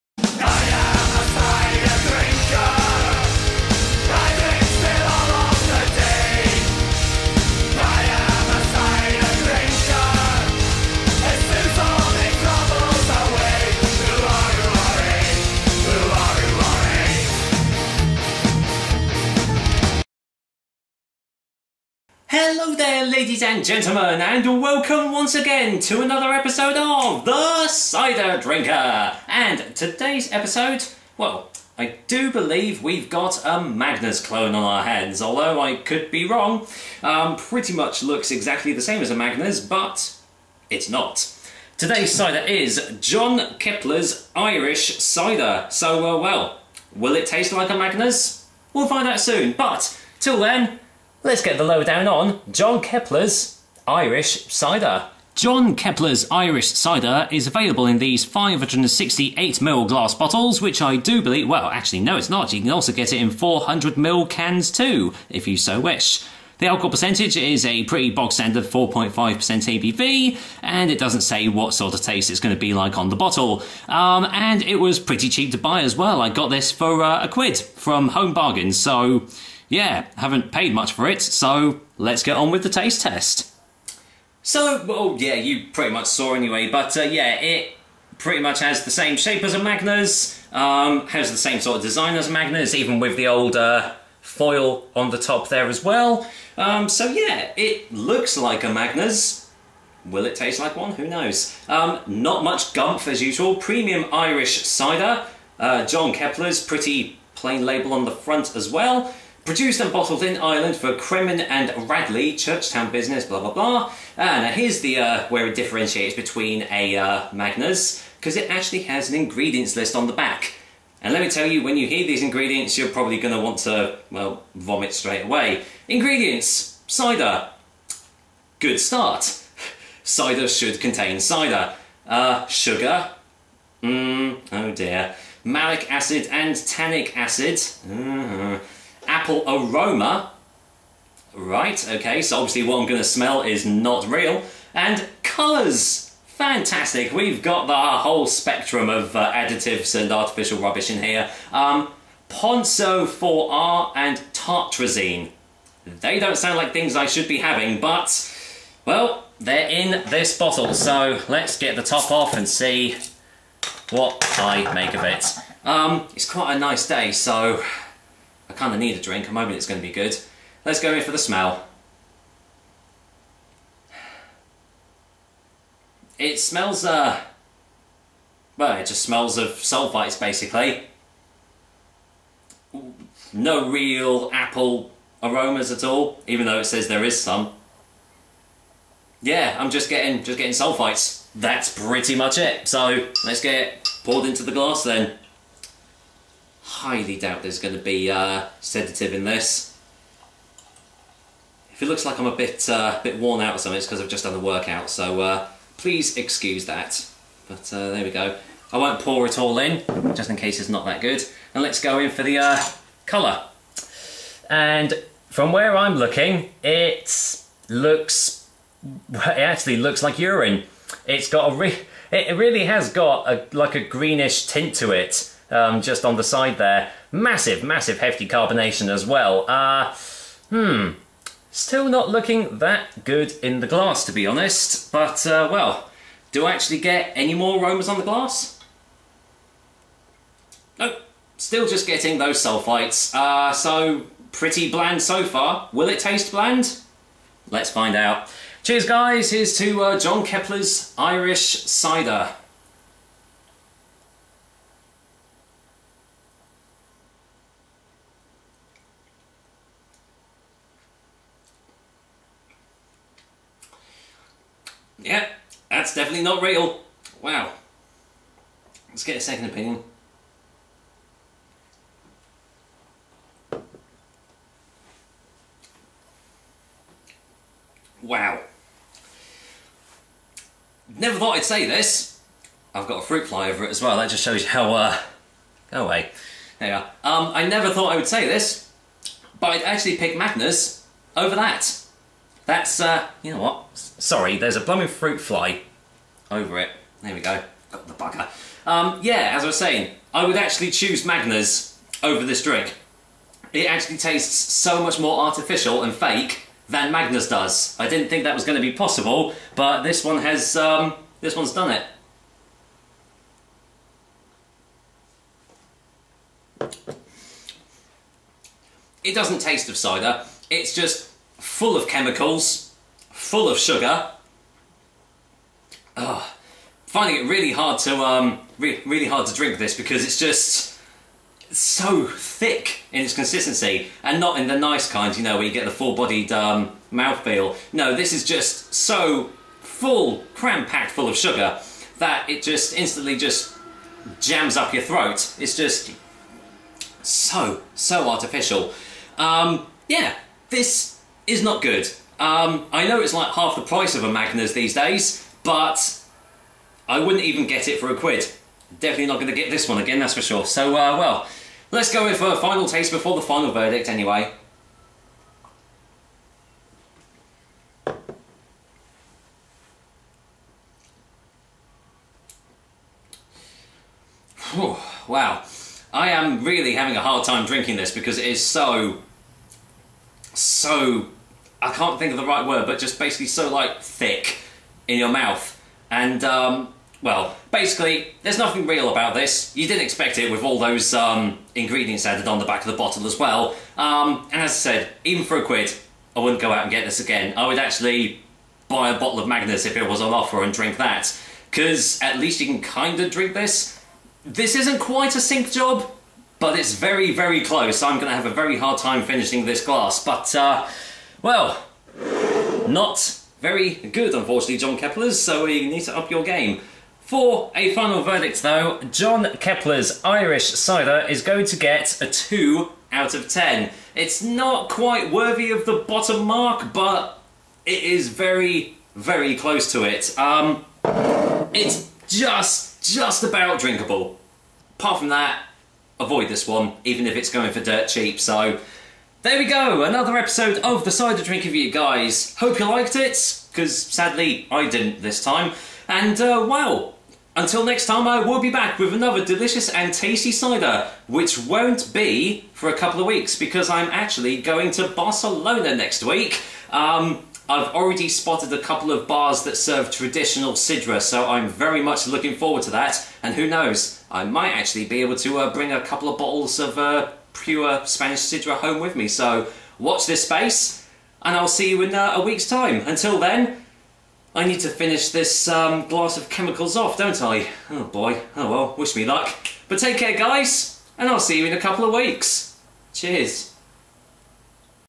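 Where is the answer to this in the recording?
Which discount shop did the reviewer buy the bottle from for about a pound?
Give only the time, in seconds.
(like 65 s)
78 s.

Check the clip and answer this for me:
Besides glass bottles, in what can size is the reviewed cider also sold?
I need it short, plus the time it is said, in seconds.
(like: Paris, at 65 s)
400ml, at 63 s.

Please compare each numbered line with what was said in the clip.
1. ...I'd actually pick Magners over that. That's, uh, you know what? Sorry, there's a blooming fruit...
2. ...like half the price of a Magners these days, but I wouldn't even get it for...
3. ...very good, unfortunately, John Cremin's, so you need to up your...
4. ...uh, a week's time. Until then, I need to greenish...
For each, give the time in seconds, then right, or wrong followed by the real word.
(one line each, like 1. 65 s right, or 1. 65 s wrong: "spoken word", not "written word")
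1. 289 s right
2. 353 s right
3. 413 s wrong: "Keppler", not "Cremin"
4. 471 s wrong: "finish", not "greenish".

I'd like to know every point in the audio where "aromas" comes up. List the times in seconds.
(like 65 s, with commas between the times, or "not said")
139 s, 185 s, 237 s.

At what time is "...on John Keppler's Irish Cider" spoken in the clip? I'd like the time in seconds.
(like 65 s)
52 s.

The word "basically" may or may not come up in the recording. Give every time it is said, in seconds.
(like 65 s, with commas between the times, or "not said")
180 s, 382 s, 387 s.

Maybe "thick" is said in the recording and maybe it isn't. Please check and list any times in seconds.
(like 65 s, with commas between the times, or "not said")
332 s, 383 s.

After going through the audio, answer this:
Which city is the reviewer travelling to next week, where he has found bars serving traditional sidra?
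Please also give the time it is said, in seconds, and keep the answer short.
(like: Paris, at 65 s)
Barcelona, at 454 s.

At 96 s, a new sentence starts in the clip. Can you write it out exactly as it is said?
Um, so yeah, it looks like a Magners.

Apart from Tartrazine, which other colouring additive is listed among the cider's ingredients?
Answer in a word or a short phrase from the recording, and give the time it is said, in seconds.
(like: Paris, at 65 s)
Ponceau 4R, at 152 s.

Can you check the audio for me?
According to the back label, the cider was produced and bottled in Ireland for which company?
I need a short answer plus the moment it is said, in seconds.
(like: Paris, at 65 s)
Cremin and Radley, at 110 s.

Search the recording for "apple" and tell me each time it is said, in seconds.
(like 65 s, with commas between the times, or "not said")
139 s, 184 s.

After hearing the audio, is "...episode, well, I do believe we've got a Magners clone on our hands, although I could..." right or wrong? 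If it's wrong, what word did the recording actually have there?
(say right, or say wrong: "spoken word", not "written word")
right.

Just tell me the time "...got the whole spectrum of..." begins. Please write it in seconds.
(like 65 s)
147 s.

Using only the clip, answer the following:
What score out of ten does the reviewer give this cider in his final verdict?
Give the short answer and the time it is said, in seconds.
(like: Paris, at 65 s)
2, at 422 s.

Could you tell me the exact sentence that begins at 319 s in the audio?
It doesn't taste of cider, it's just full of chemicals, full of sugar.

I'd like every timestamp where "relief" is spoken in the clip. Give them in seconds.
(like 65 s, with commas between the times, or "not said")
not said.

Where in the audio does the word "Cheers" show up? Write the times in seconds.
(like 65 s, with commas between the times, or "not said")
248 s, 482 s.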